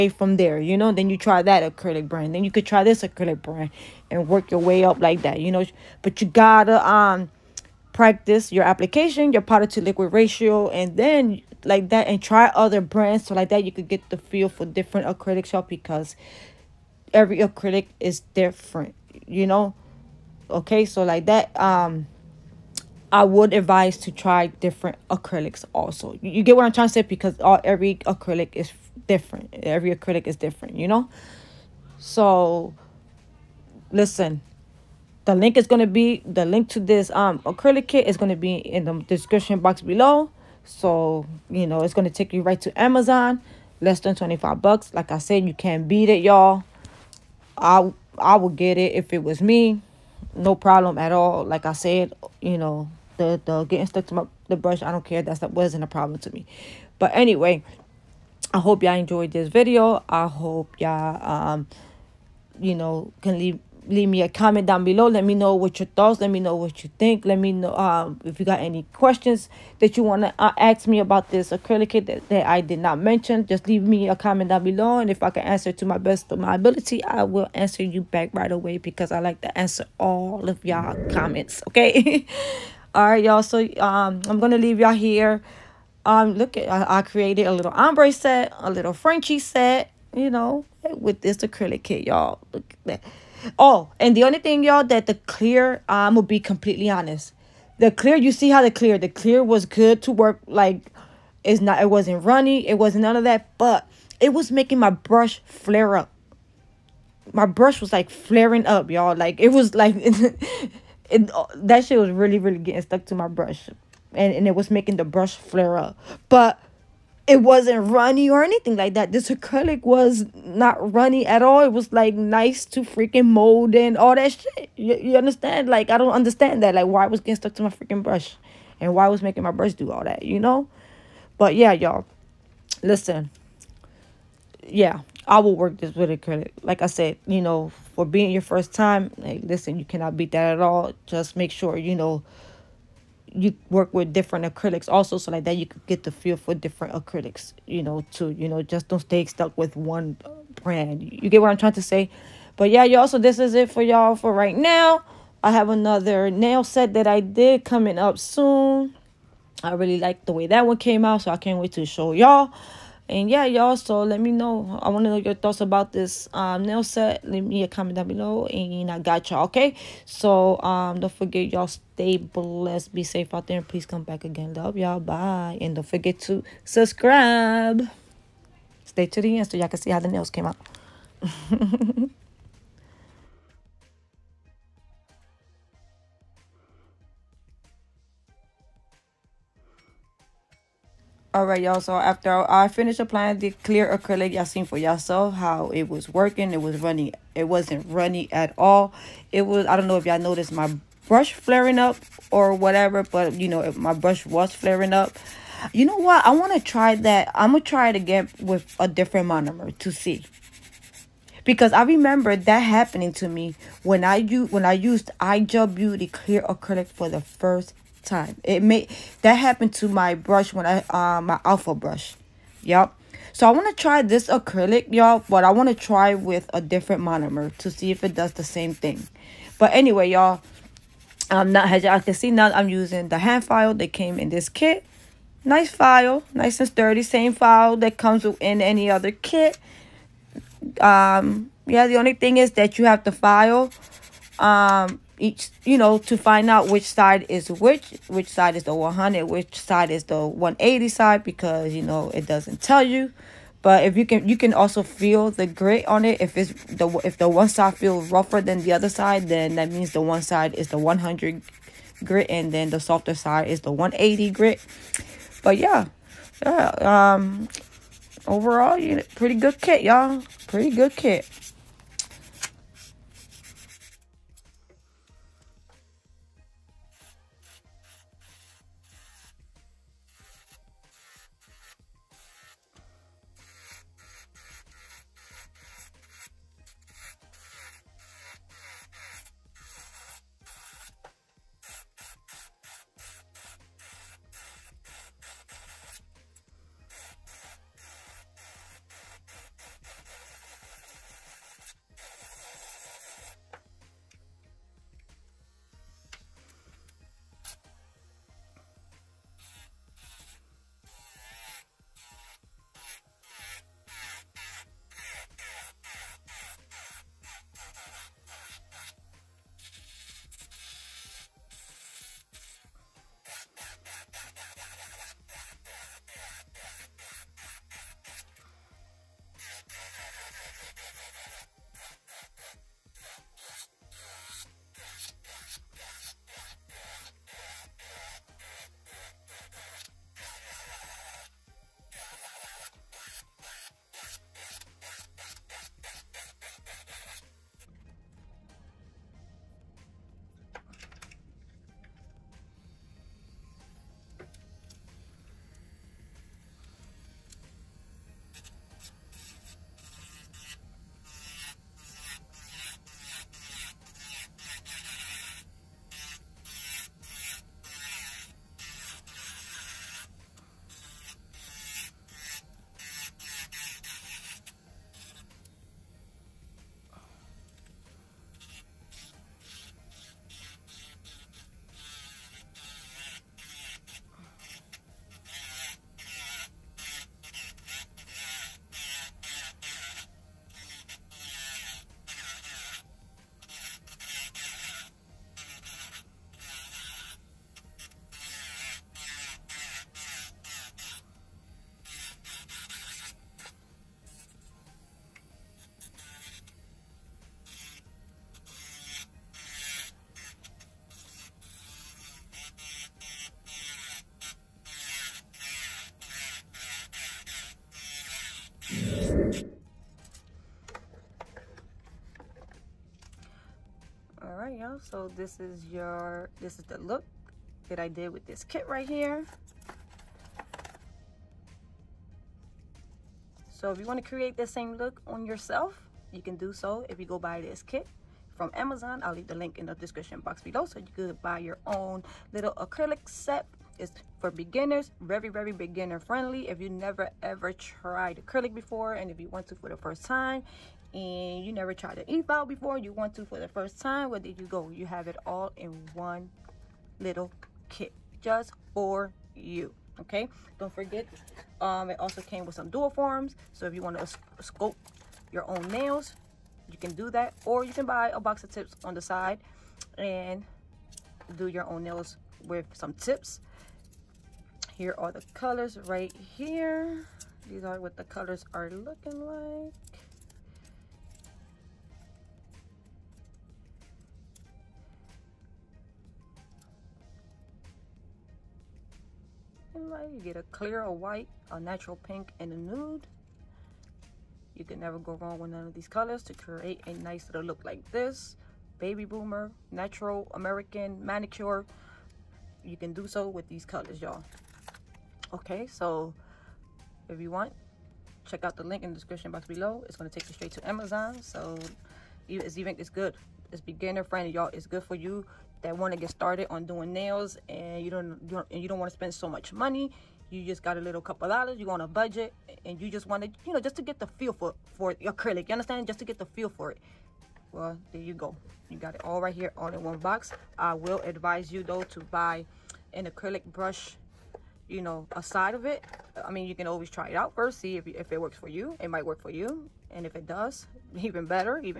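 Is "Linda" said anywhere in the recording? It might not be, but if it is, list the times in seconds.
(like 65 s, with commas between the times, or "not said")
not said.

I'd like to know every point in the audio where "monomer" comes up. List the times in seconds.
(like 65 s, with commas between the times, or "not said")
209 s, 227 s.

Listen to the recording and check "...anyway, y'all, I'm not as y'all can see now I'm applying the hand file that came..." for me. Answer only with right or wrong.
wrong.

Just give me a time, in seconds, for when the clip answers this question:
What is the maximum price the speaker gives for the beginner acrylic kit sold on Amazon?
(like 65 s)
43 s.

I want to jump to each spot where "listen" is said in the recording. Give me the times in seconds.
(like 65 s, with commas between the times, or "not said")
33 s, 132 s, 139 s.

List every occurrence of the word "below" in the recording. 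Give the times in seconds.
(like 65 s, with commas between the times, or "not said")
39 s, 64 s, 74 s, 168 s, 440 s, 509 s.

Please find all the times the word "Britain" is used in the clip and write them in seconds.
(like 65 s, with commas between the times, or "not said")
not said.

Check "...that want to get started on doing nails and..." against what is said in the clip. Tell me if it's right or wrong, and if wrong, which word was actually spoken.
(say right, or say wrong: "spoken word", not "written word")
right.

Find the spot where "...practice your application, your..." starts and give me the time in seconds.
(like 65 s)
7 s.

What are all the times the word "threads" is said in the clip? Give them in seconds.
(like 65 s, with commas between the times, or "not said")
not said.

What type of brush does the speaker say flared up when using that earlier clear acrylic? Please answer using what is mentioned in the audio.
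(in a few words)
alpha brush.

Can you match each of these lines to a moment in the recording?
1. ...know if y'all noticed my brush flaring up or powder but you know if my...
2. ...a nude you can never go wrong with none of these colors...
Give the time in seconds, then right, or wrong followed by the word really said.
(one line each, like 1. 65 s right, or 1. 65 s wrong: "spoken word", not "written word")
1. 199 s wrong: "whatever", not "powder"
2. 492 s right.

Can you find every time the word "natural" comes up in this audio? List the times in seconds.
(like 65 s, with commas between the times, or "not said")
491 s, 499 s.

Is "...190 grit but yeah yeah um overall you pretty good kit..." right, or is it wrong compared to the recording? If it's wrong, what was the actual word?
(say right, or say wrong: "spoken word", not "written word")
wrong: "180", not "190".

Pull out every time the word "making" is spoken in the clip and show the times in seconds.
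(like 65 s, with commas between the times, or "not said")
104 s, 114 s, 129 s.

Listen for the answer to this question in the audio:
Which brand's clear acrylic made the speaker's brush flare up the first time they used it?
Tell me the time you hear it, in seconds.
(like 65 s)
215 s.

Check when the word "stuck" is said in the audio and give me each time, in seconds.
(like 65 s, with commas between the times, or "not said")
53 s, 112 s, 127 s, 149 s.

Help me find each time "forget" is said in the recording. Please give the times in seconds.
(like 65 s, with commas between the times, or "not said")
171 s, 175 s, 460 s.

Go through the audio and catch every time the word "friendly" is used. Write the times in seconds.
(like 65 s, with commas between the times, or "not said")
445 s, 514 s.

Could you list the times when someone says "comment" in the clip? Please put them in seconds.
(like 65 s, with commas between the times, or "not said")
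64 s, 74 s, 81 s, 167 s.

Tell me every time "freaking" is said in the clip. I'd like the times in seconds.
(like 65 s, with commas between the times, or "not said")
122 s, 127 s.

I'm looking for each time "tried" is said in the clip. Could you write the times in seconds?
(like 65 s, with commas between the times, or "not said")
447 s, 451 s.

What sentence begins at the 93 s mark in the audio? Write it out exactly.
Oh, and the only thing, y'all, that the clear, I'm going to be completely honest.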